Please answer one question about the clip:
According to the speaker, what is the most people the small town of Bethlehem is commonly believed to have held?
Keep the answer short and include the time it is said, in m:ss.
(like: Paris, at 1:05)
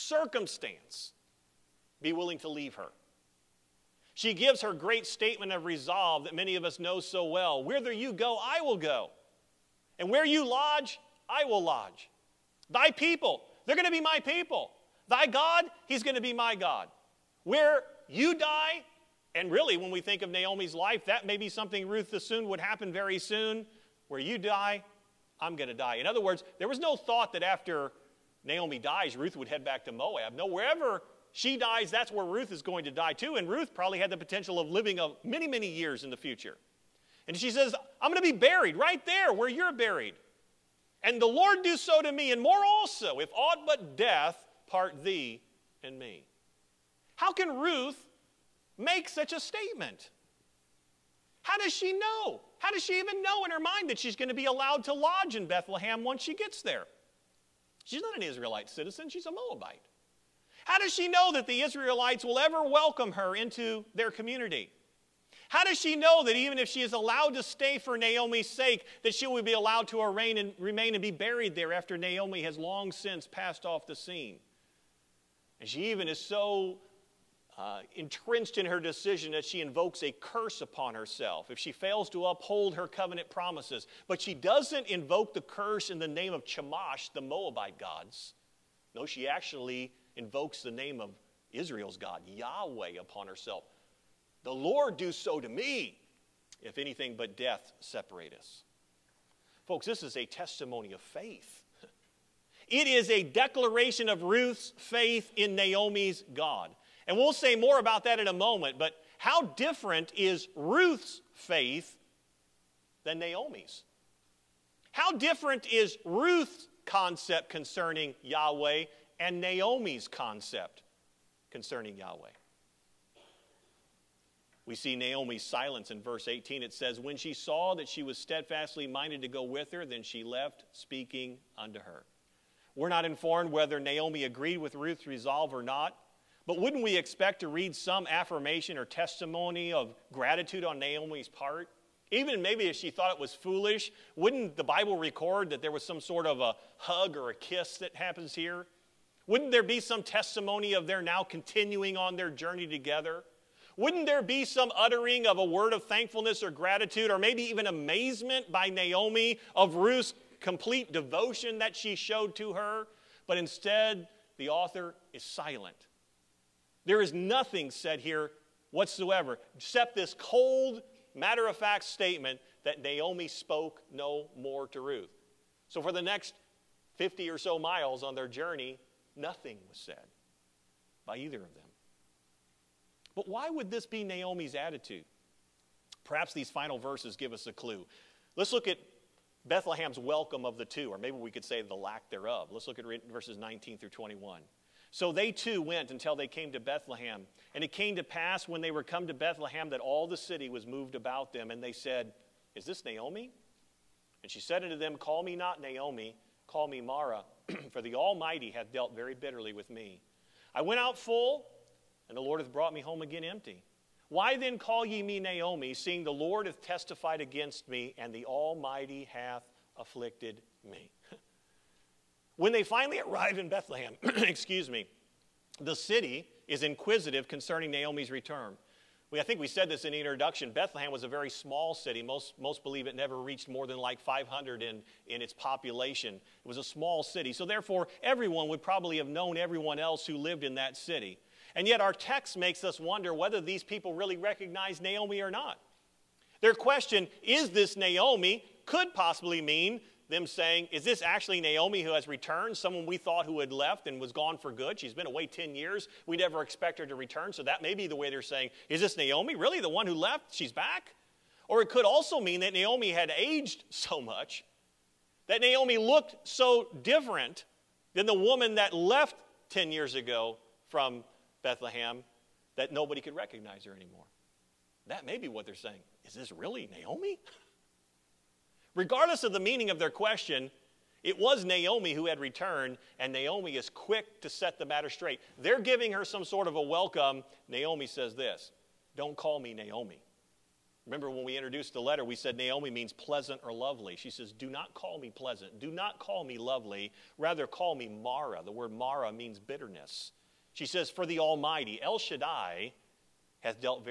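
500, at 3:54.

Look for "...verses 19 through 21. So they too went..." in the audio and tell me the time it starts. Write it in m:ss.
3:13.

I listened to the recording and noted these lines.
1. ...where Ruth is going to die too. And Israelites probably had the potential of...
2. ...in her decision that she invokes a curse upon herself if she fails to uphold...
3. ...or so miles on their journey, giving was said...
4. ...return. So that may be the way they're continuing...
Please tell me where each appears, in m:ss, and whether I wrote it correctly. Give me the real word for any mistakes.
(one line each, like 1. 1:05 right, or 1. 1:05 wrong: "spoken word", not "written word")
1. 0:32 wrong: "Ruth", not "Israelites"
2. 1:18 right
3. 2:57 wrong: "nothing", not "giving"
4. 4:16 wrong: "saying", not "continuing".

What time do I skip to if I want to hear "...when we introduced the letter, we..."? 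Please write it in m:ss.
4:51.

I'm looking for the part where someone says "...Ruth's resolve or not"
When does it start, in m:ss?
2:14.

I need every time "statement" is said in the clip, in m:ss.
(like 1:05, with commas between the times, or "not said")
0:05, 0:49, 2:51.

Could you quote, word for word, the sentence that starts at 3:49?
We, I think we said this in the introduction.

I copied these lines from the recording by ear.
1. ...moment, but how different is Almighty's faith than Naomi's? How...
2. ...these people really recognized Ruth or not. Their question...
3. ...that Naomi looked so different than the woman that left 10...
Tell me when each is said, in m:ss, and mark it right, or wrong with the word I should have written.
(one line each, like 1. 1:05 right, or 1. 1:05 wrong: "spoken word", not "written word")
1. 1:48 wrong: "Ruth", not "Almighty"
2. 4:03 wrong: "Naomi", not "Ruth"
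3. 4:25 right.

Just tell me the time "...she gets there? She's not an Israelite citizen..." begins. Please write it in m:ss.
0:56.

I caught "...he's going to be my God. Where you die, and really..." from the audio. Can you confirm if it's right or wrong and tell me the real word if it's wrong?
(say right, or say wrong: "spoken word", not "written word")
right.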